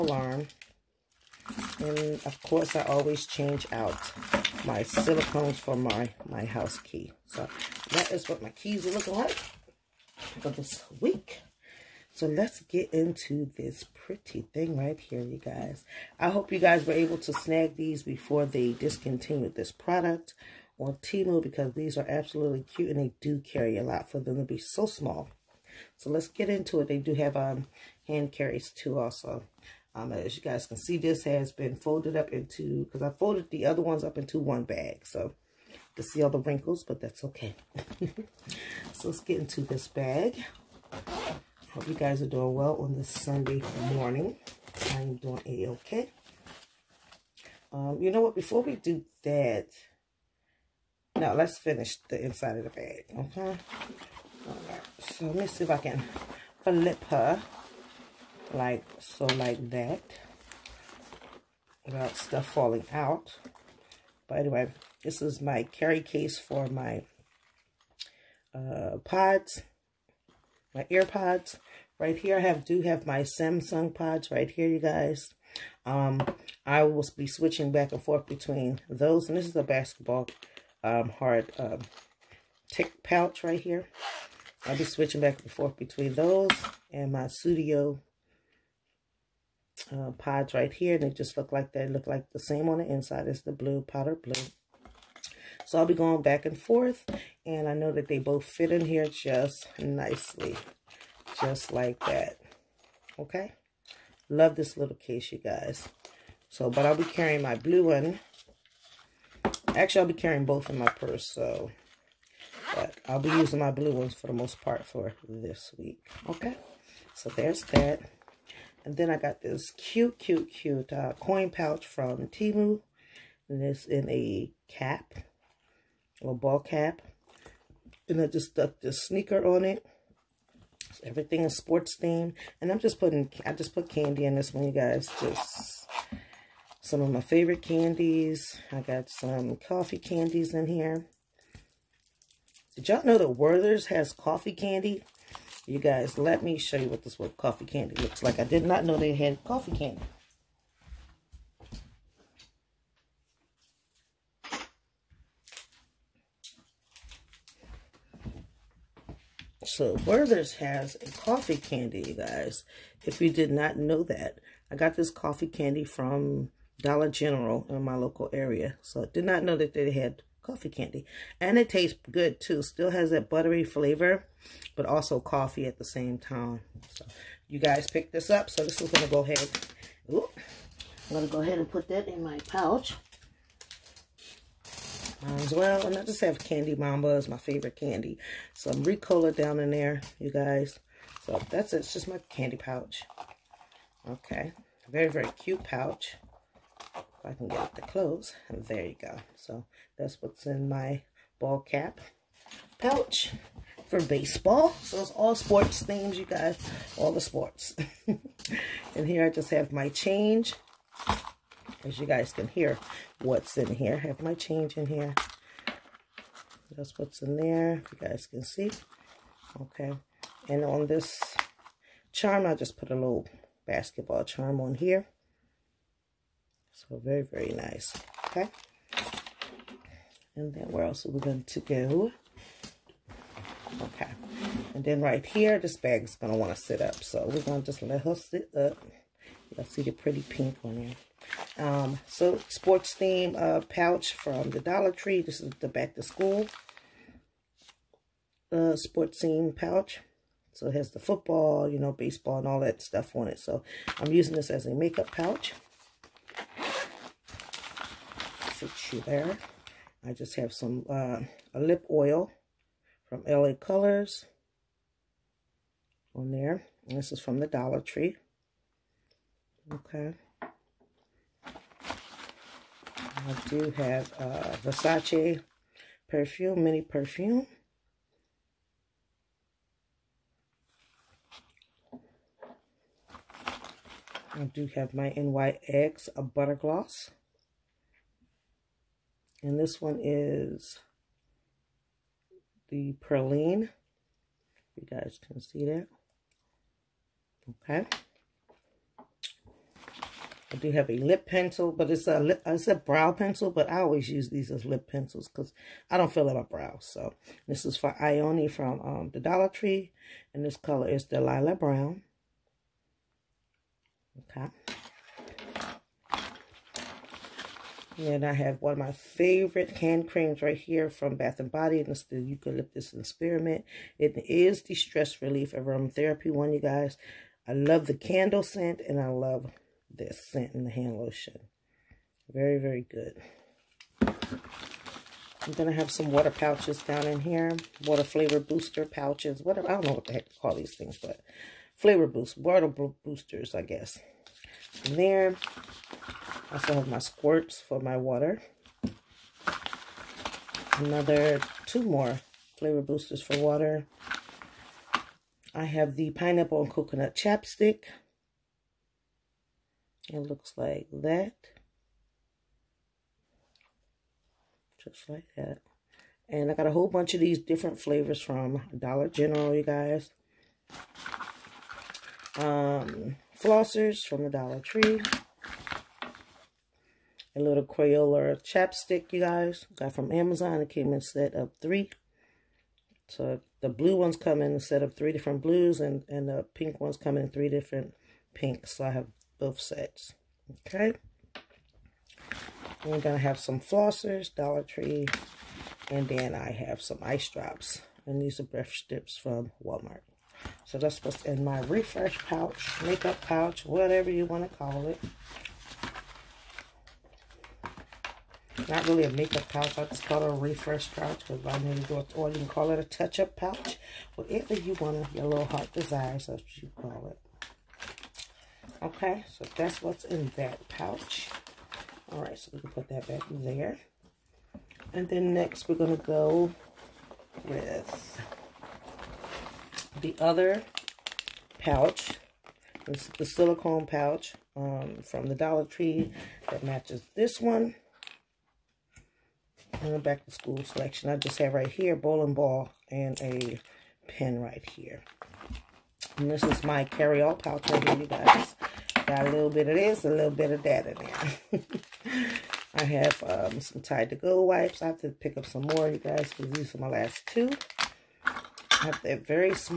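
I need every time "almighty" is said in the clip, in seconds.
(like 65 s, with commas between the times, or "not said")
not said.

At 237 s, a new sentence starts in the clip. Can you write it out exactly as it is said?
So we're going to just let her sit up.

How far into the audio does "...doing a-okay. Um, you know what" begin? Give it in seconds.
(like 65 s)
45 s.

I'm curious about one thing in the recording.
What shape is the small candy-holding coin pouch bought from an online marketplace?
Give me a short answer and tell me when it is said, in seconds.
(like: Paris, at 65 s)
A ball cap, at 126 s.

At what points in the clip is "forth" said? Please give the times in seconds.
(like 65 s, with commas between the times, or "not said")
78 s, 85 s, 96 s.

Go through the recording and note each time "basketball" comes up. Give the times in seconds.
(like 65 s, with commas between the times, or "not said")
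79 s, 223 s.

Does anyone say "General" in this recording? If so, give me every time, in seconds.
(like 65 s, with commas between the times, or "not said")
167 s, 369 s.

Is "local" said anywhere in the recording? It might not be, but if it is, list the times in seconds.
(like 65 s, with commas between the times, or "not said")
167 s.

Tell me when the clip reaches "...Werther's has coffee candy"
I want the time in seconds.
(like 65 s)
143 s.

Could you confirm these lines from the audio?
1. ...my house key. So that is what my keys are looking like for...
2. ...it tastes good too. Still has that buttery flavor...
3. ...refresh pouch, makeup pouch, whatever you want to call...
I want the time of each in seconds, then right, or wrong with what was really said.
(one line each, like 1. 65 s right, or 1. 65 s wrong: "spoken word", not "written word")
1. 6 s right
2. 171 s right
3. 401 s right.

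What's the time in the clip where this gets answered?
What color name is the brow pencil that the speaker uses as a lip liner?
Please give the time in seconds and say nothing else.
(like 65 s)
311 s.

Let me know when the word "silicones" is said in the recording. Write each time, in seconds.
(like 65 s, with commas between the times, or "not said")
4 s, 433 s.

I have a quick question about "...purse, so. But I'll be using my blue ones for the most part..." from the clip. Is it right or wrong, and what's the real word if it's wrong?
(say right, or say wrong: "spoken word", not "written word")
right.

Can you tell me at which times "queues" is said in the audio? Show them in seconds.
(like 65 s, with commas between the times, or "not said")
not said.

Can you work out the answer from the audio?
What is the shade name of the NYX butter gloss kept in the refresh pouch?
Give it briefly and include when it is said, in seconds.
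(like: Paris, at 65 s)
Praline, at 292 s.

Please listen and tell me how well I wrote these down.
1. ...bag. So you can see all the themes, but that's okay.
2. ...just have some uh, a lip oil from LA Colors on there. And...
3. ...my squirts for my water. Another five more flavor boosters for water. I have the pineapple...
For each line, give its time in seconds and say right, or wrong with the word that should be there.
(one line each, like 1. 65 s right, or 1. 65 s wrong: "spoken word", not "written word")
1. 34 s wrong: "wrinkles", not "themes"
2. 260 s right
3. 346 s wrong: "two", not "five".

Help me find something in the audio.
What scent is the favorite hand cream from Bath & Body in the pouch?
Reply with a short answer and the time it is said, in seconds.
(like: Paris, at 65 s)
Eucalyptus and Spearmint, at 322 s.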